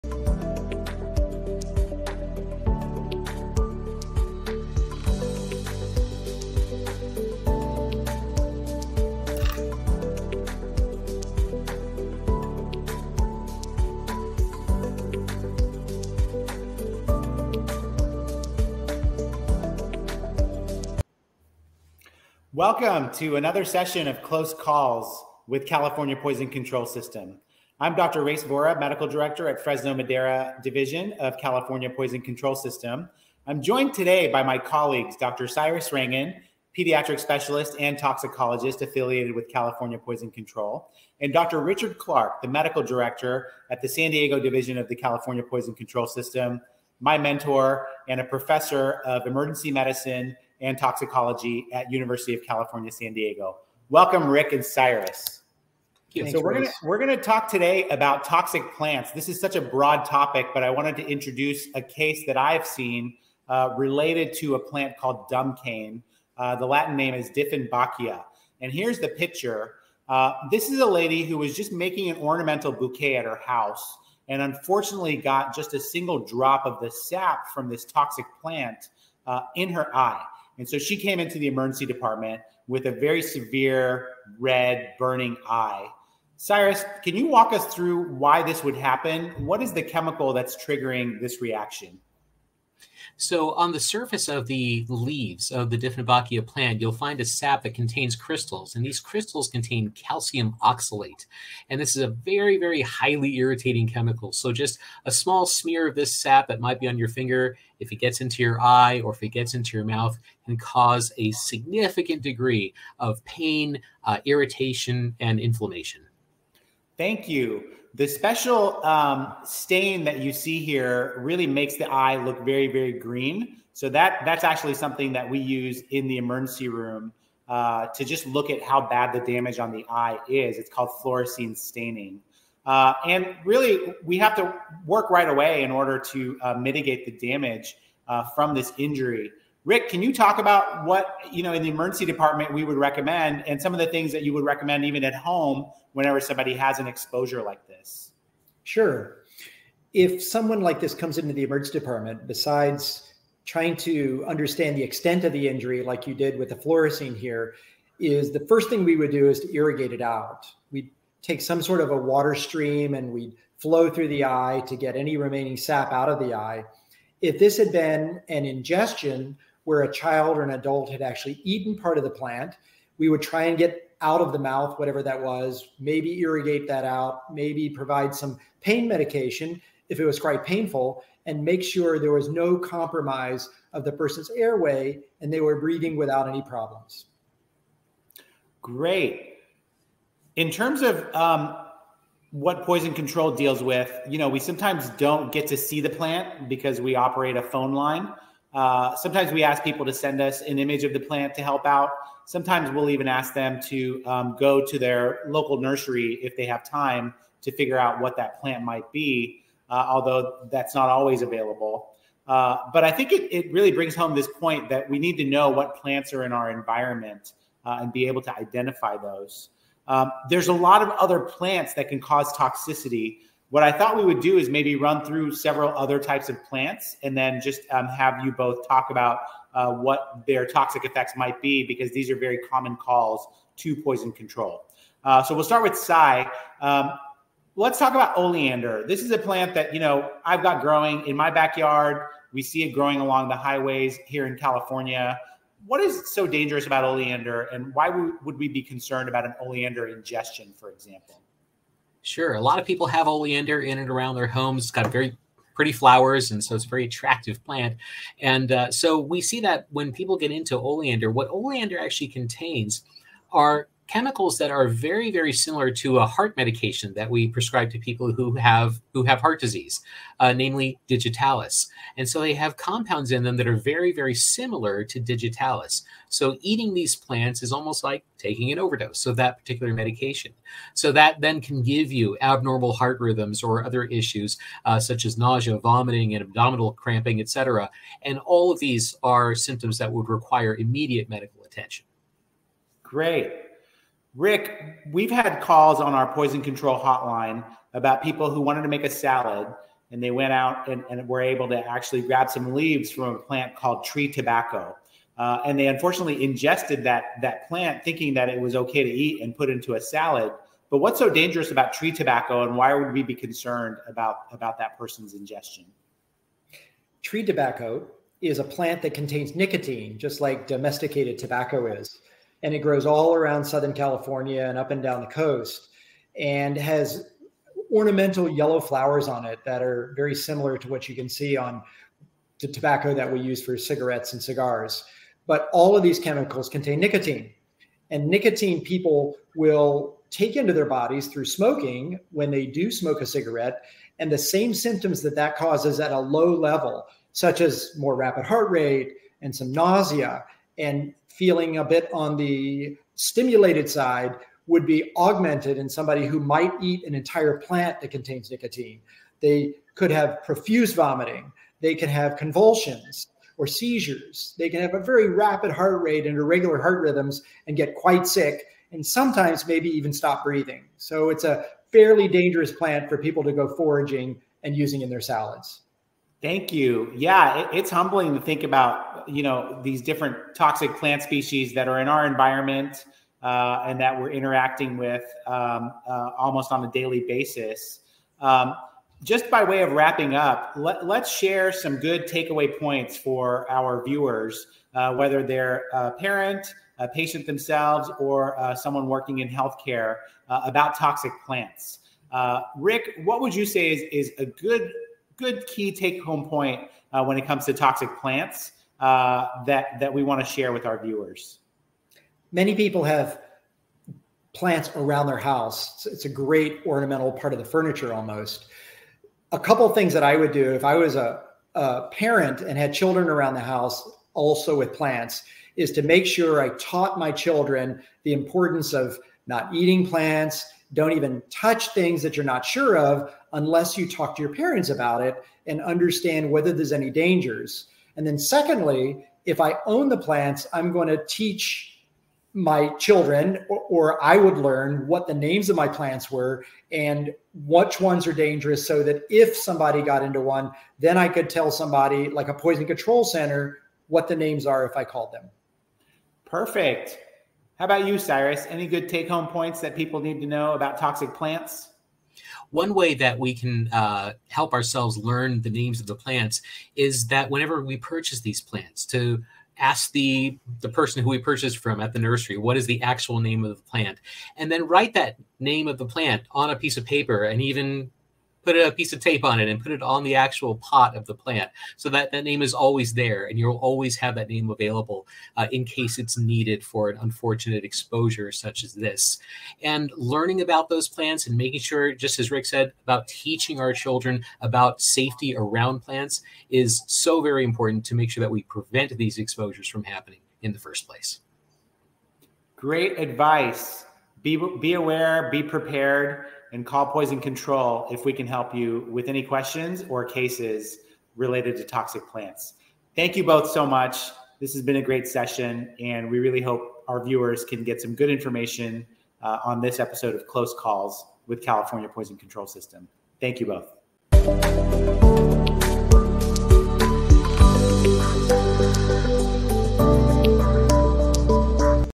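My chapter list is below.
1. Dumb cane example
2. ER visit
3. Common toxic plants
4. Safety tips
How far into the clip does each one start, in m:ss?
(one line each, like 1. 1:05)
1. 0:56
2. 2:19
3. 3:39
4. 6:28.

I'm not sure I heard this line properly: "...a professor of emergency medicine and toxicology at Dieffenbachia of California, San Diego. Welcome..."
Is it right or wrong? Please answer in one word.
wrong.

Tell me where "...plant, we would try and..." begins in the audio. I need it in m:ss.
2:52.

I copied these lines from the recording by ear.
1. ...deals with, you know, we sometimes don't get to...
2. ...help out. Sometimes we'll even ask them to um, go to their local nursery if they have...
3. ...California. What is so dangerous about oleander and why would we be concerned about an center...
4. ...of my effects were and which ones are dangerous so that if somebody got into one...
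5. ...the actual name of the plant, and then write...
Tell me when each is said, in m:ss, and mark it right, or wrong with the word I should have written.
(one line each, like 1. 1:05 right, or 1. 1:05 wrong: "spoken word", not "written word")
1. 3:13 right
2. 3:21 right
3. 4:04 wrong: "oleander", not "center"
4. 7:25 wrong: "plants", not "effects"
5. 7:52 right.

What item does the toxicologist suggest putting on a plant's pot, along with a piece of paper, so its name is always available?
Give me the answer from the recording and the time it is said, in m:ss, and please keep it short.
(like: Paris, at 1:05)
tape, at 7:58.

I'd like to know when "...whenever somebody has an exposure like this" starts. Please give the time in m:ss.
2:25.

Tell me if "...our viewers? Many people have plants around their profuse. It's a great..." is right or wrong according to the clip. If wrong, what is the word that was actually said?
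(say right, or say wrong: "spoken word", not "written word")
wrong: "house", not "profuse".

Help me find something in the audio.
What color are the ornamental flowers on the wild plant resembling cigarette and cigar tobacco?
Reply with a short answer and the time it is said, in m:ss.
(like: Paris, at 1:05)
yellow, at 5:28.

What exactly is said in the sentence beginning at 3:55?
Uh, so we'll start with Cy.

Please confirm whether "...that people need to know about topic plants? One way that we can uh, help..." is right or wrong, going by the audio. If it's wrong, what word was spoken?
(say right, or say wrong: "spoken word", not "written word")
wrong: "toxic", not "topic".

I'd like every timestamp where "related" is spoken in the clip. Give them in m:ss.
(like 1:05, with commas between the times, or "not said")
1:03, 8:31.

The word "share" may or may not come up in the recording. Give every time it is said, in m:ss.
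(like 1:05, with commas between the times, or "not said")
6:31, 6:50.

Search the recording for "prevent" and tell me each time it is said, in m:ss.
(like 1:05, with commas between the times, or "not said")
8:18.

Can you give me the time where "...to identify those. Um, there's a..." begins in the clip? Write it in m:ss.
3:38.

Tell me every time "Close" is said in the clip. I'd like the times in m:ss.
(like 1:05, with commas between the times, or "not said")
0:24, 8:40.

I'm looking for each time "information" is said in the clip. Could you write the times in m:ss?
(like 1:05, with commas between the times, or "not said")
8:38.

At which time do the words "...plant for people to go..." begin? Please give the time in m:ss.
6:12.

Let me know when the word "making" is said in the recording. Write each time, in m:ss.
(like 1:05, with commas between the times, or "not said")
1:11, 8:11.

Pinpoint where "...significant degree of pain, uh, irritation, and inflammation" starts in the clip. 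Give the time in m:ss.
1:51.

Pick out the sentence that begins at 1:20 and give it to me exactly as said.
And so she came into the emergency department with a very severe red burning eye.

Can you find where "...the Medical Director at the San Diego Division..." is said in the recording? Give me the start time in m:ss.
0:42.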